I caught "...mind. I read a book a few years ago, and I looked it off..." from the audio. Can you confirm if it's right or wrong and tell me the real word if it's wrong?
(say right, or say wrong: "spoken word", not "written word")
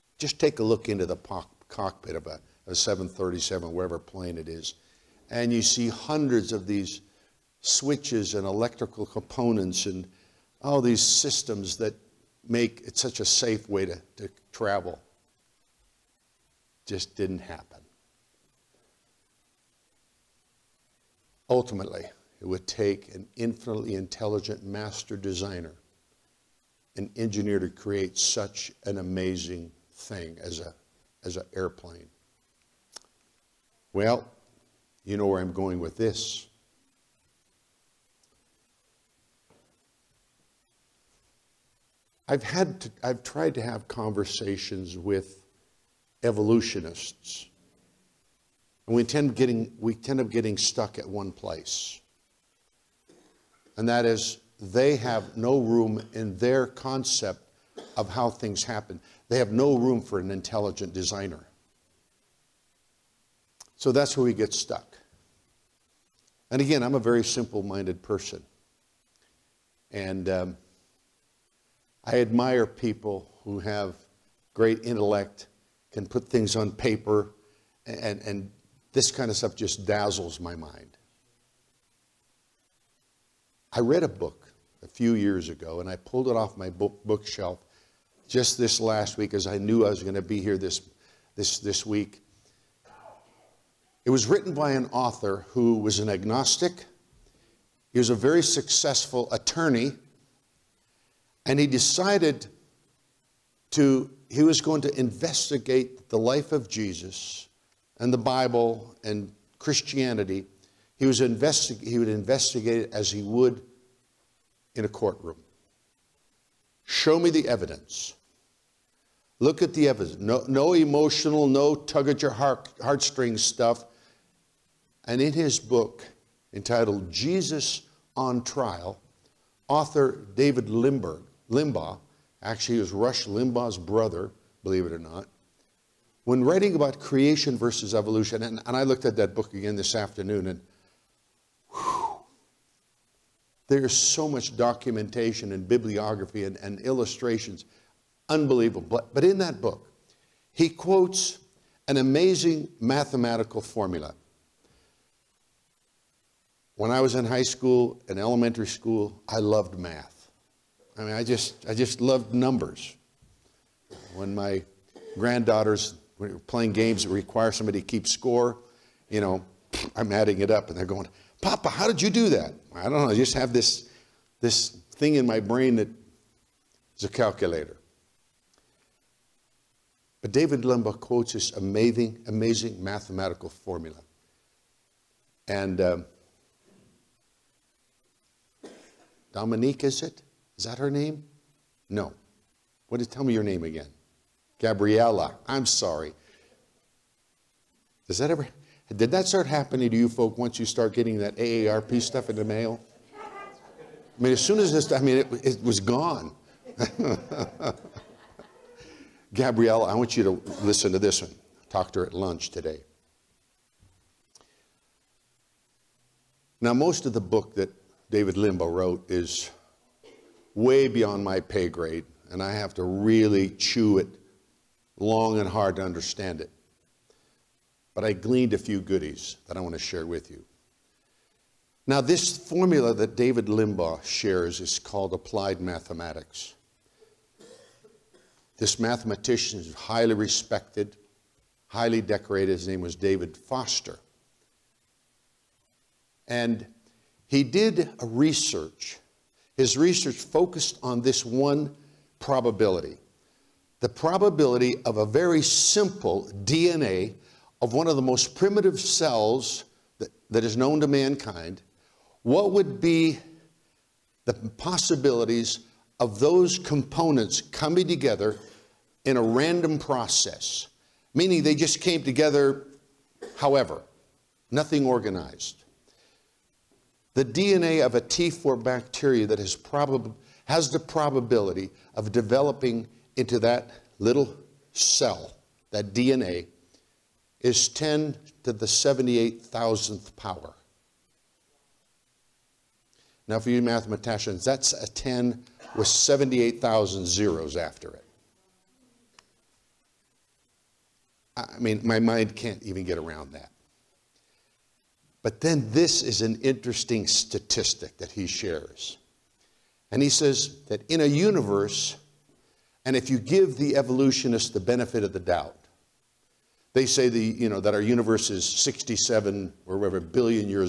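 wrong: "pulled", not "looked".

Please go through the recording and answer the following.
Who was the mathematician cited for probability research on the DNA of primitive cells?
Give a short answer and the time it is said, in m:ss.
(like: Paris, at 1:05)
David Foster, at 4:02.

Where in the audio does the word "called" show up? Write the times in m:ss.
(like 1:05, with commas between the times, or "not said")
3:54.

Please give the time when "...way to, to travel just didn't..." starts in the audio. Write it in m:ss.
0:13.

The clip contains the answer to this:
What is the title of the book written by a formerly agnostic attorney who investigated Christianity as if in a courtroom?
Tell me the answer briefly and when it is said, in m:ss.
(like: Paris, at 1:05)
Jesus on Trial, at 2:07.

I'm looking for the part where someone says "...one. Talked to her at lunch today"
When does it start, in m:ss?
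3:31.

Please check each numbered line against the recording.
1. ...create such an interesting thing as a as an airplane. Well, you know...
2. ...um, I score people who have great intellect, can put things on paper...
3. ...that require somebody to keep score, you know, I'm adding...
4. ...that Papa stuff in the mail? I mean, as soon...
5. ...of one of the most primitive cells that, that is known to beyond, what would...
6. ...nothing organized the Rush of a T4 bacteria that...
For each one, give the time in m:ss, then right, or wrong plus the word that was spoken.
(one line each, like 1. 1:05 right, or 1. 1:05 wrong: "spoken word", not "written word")
1. 0:27 wrong: "amazing", not "interesting"
2. 1:10 wrong: "admire", not "score"
3. 2:47 right
4. 3:21 wrong: "AARP", not "Papa"
5. 4:17 wrong: "mankind", not "beyond"
6. 4:34 wrong: "DNA", not "Rush".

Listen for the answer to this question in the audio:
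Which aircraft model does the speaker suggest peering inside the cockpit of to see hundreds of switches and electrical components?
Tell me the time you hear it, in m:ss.
0:02.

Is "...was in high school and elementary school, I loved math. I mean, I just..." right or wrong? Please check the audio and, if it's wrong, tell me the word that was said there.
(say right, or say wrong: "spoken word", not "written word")
right.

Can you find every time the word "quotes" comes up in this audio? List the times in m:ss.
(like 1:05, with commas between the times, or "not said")
2:30, 3:01.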